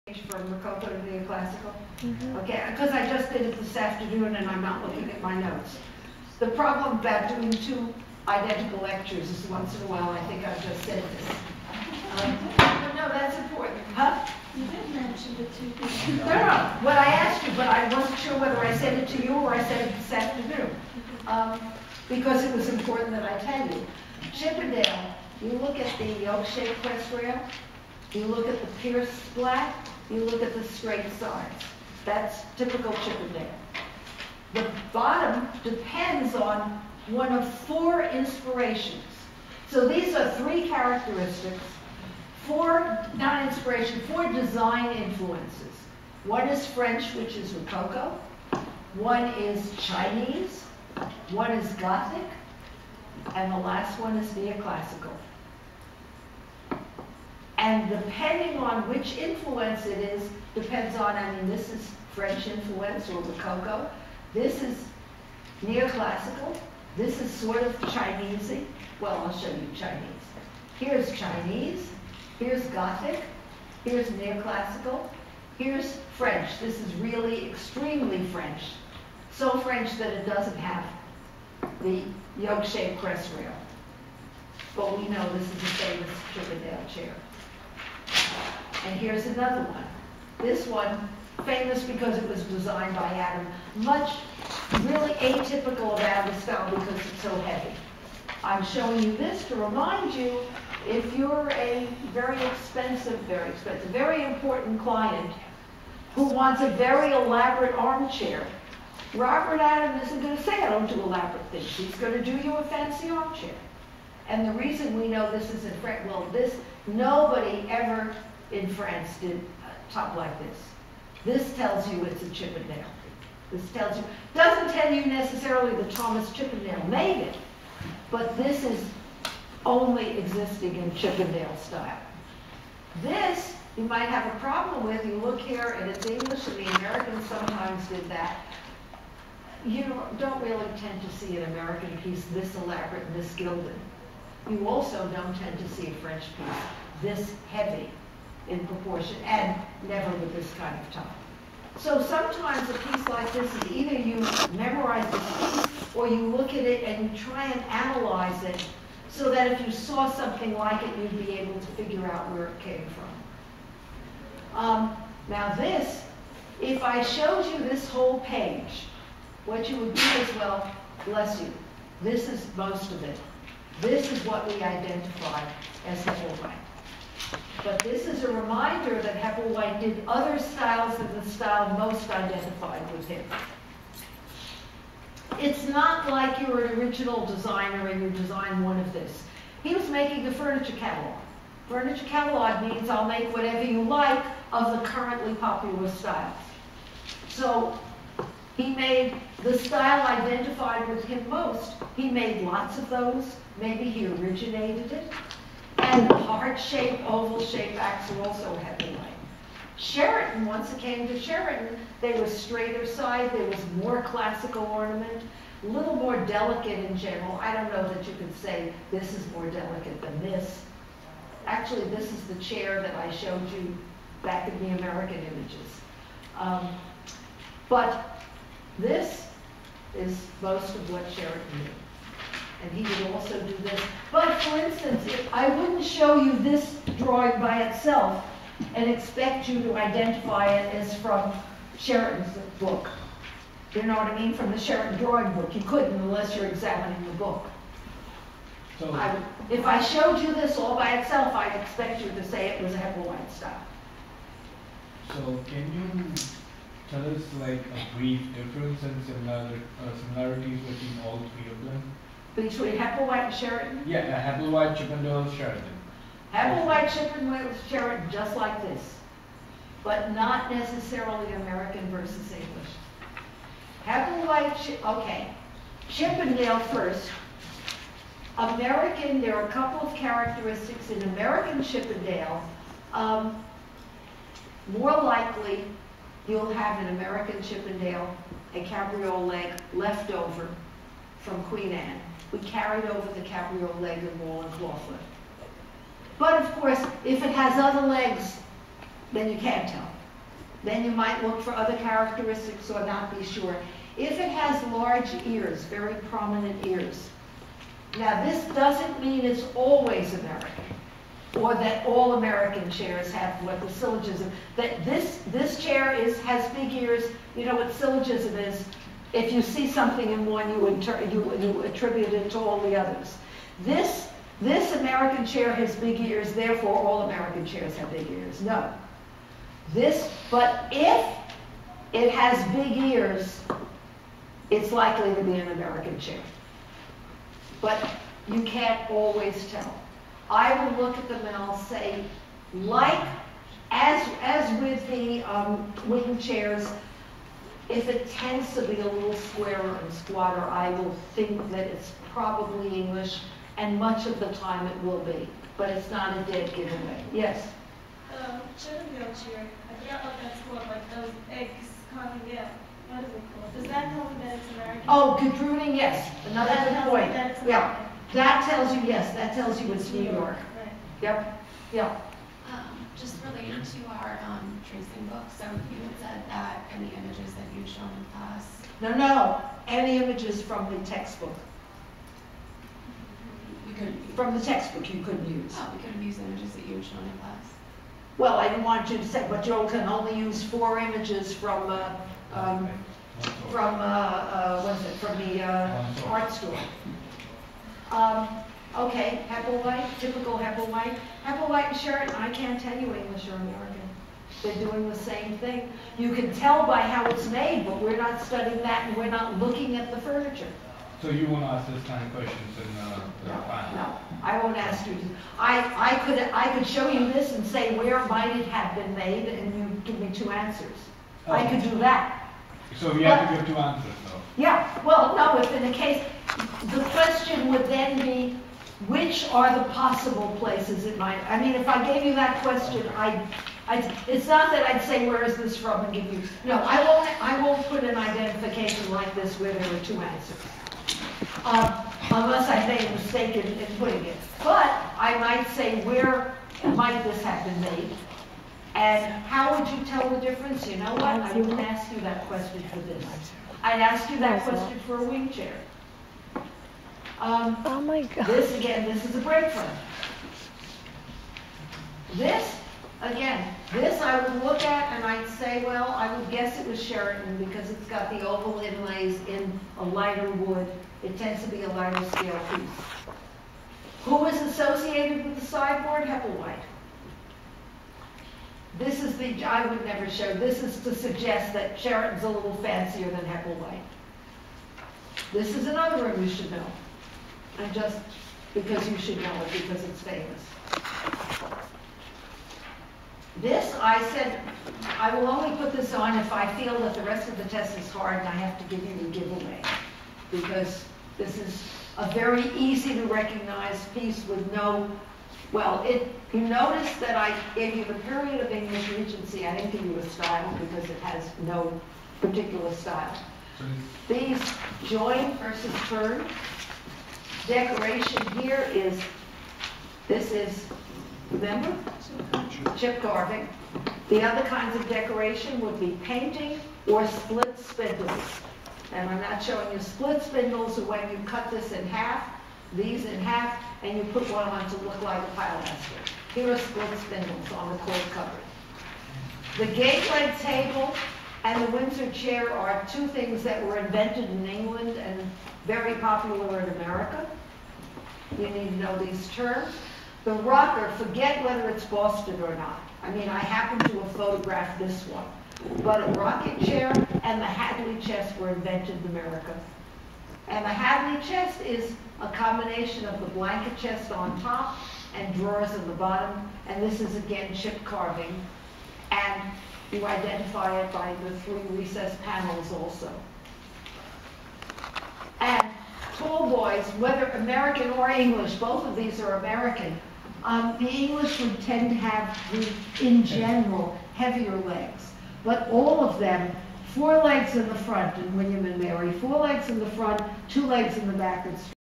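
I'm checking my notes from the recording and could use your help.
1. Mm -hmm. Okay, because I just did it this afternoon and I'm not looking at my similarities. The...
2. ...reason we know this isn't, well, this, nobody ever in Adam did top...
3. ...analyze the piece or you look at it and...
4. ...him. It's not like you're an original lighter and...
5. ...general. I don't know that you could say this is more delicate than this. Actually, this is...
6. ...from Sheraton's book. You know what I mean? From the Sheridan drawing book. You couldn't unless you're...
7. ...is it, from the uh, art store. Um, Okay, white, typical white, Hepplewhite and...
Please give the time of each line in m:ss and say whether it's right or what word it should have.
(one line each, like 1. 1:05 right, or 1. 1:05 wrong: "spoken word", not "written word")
1. 0:02 wrong: "notes", not "similarities"
2. 1:54 wrong: "France", not "Adam"
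3. 2:34 wrong: "memorize", not "analyze"
4. 3:03 wrong: "designer", not "lighter"
5. 3:36 right
6. 4:00 right
7. 6:34 right.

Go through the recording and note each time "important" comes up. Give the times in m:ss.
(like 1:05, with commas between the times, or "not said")
0:13, 0:22, 1:44.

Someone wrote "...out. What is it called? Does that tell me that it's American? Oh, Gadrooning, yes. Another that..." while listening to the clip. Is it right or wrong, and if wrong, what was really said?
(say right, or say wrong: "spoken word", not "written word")
right.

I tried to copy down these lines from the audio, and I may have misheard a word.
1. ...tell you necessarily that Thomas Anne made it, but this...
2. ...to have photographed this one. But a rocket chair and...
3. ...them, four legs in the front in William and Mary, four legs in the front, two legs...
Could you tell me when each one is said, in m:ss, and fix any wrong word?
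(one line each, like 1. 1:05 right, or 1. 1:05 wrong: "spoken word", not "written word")
1. 2:04 wrong: "Chippendale", not "Anne"
2. 9:13 right
3. 9:46 right.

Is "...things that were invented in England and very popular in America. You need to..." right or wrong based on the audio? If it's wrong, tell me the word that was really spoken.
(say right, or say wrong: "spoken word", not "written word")
right.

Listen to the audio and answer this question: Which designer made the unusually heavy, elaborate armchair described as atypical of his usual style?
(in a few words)
Robert Adam.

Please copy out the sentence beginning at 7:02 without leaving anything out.
So you but, have to give two answers though?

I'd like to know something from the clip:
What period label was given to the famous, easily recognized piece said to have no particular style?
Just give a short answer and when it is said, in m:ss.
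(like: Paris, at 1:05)
English Regency, at 8:28.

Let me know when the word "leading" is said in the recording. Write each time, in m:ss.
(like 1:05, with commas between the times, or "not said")
not said.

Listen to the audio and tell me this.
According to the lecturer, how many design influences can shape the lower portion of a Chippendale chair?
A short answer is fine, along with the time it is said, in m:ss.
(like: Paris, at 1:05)
4, at 0:44.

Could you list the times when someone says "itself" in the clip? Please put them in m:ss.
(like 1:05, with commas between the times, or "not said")
3:57, 4:10.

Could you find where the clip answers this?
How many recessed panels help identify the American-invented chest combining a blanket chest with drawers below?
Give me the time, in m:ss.
9:31.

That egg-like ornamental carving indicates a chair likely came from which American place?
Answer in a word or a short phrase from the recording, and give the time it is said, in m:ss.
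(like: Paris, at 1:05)
New York, at 6:09.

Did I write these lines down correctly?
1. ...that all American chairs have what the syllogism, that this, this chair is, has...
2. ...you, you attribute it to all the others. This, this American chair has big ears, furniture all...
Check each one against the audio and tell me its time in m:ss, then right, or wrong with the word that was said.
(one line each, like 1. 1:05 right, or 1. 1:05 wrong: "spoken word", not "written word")
1. 5:11 right
2. 5:20 wrong: "therefore", not "furniture".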